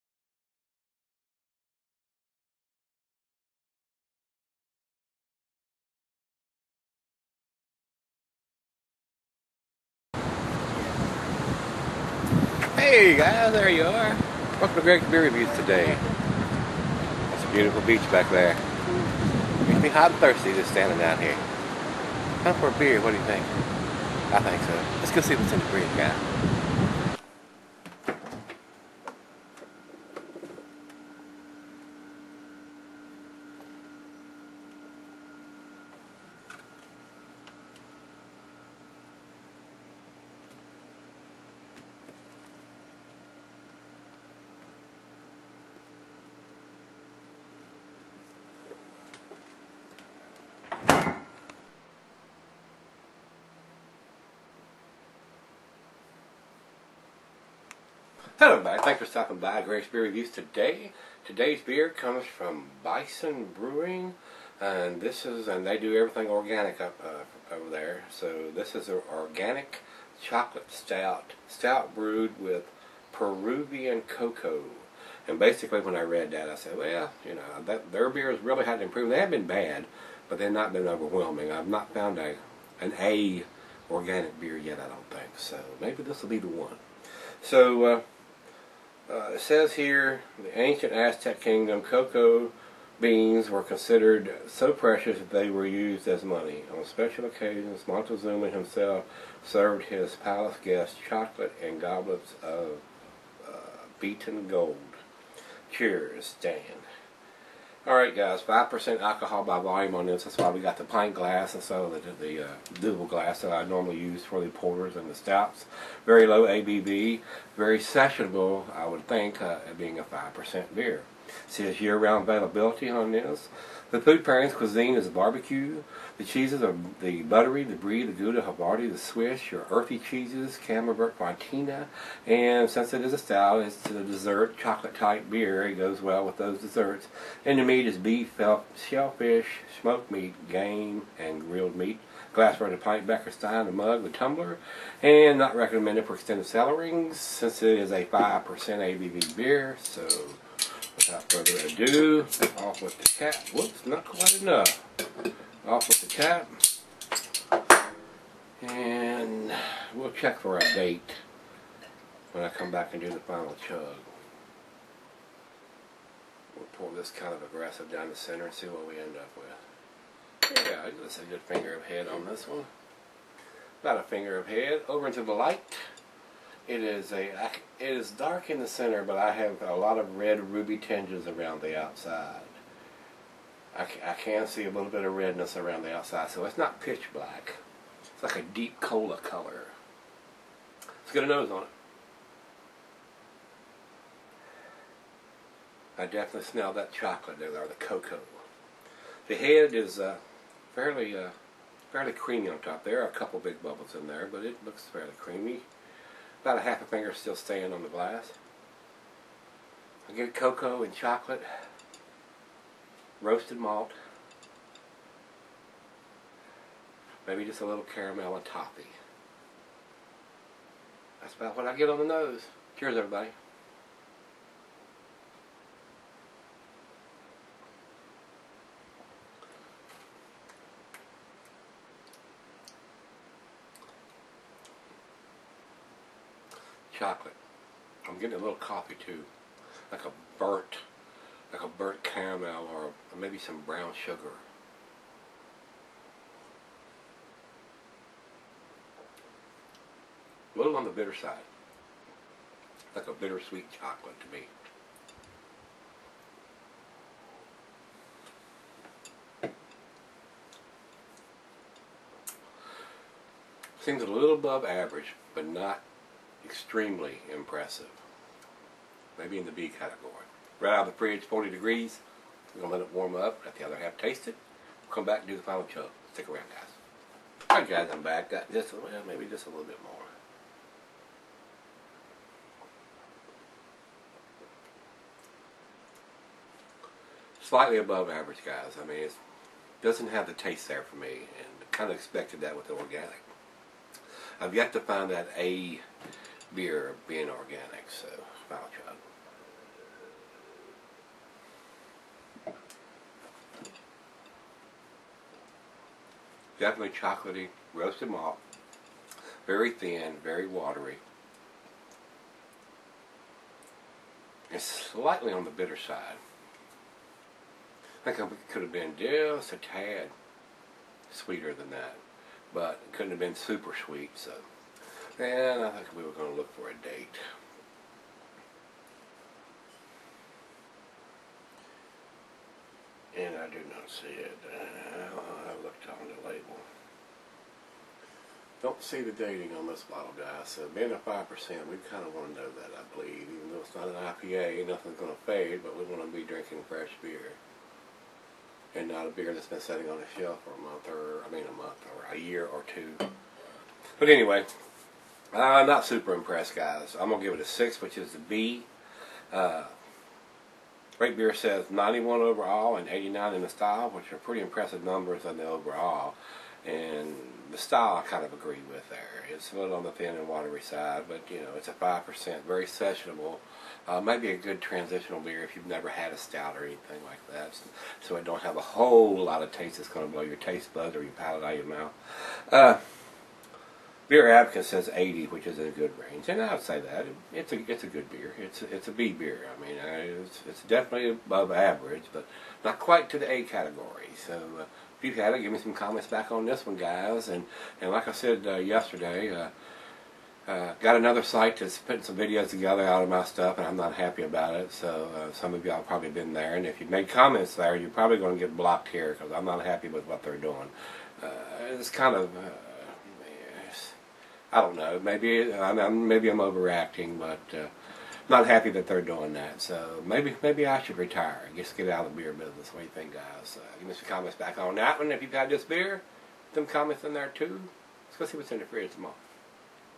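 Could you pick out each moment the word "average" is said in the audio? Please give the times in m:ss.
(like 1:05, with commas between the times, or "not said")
4:24, 4:48, 6:31.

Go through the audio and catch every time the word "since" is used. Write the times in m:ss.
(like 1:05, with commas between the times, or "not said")
2:12, 2:27.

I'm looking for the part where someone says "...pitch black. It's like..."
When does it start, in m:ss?
3:06.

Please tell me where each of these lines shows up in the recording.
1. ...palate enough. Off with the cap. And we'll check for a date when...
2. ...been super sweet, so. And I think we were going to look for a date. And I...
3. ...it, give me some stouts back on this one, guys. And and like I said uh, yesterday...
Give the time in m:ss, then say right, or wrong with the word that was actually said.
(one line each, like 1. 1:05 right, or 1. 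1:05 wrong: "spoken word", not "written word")
1. 2:34 wrong: "quite", not "palate"
2. 5:23 right
3. 6:35 wrong: "comments", not "stouts".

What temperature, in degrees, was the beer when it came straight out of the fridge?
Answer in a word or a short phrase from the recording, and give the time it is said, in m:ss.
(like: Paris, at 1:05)
40, at 4:31.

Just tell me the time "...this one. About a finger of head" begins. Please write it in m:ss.
2:52.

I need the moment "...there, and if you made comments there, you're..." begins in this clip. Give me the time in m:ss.
6:46.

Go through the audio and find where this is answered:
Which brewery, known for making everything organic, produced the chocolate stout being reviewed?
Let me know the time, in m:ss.
1:02.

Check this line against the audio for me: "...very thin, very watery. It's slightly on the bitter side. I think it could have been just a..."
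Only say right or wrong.
right.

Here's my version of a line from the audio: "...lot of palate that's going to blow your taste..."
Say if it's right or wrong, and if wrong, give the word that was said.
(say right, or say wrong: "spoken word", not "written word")
wrong: "taste", not "palate".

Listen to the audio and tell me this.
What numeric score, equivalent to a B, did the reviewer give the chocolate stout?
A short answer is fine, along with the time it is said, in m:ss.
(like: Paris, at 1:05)
6, at 5:57.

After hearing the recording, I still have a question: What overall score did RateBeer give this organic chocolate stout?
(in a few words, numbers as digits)
91.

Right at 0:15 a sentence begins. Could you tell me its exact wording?
That's a beautiful beach back there.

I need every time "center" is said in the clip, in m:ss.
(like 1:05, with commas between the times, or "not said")
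2:48, 2:58.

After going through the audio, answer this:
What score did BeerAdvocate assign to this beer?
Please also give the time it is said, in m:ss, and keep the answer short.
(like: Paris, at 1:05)
80, at 6:24.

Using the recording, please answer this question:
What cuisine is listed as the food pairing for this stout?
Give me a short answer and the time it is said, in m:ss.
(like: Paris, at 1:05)
Barbecue, at 2:05.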